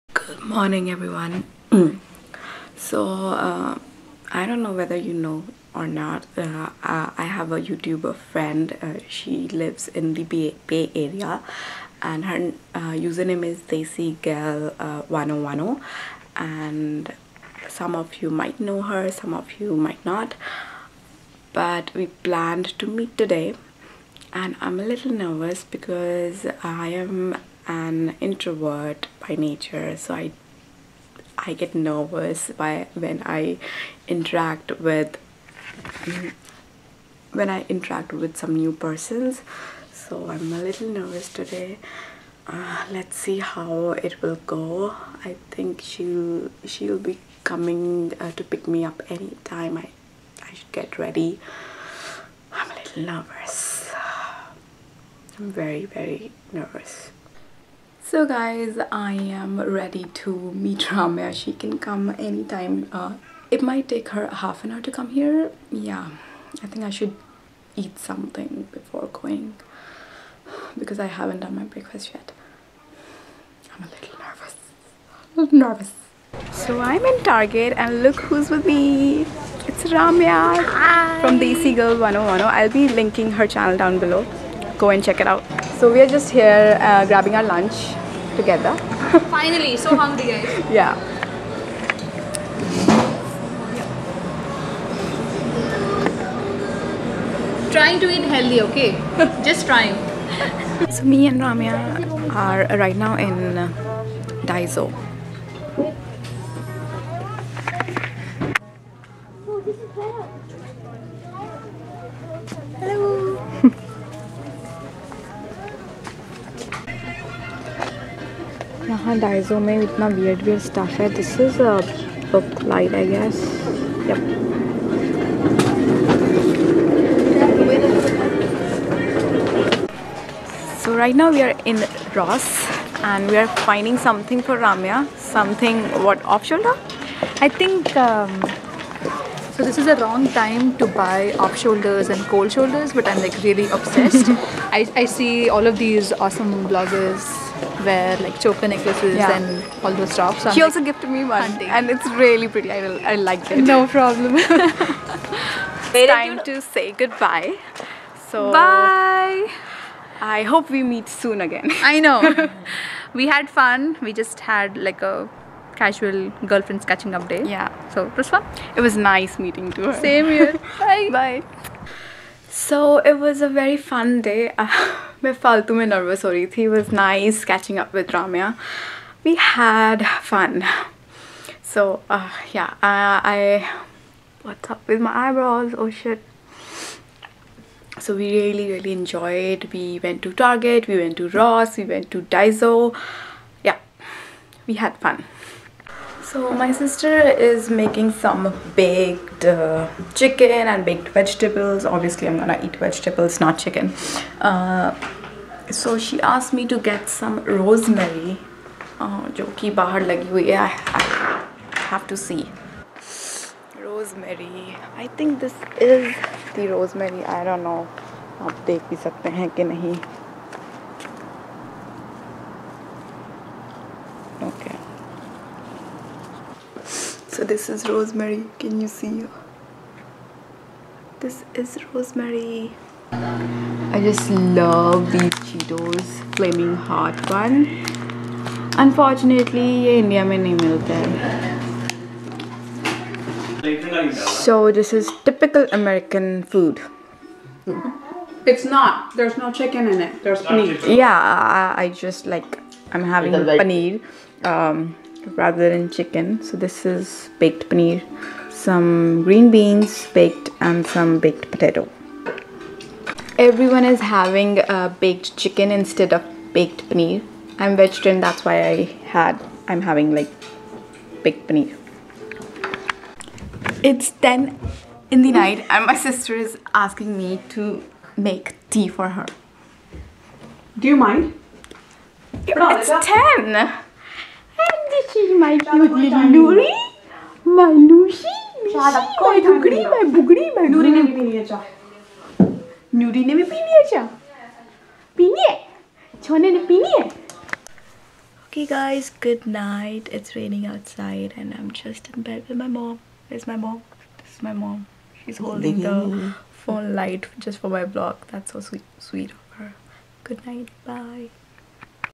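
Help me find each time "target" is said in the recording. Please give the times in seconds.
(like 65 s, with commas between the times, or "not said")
77 s, 190 s.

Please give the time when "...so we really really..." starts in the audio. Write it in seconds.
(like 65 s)
188 s.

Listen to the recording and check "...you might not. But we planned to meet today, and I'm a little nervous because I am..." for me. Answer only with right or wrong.
right.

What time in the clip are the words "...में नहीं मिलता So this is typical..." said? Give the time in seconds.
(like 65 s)
240 s.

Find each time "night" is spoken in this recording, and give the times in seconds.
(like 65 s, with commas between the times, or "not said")
275 s, 299 s, 310 s.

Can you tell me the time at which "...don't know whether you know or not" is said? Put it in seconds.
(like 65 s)
4 s.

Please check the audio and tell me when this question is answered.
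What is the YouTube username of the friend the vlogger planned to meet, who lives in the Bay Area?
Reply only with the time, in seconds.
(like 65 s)
13 s.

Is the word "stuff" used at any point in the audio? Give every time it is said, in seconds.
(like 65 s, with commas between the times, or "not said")
120 s, 150 s.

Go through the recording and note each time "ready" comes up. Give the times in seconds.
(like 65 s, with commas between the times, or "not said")
50 s, 59 s.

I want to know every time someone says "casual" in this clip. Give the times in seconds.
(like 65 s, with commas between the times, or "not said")
165 s.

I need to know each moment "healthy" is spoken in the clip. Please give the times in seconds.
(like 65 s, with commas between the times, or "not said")
98 s.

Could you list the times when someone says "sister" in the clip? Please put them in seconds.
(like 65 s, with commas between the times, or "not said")
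196 s, 275 s.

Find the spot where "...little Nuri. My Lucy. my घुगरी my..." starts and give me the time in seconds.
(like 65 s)
285 s.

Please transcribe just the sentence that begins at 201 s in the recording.
Obviously, I'm gonna eat vegetables, not chicken.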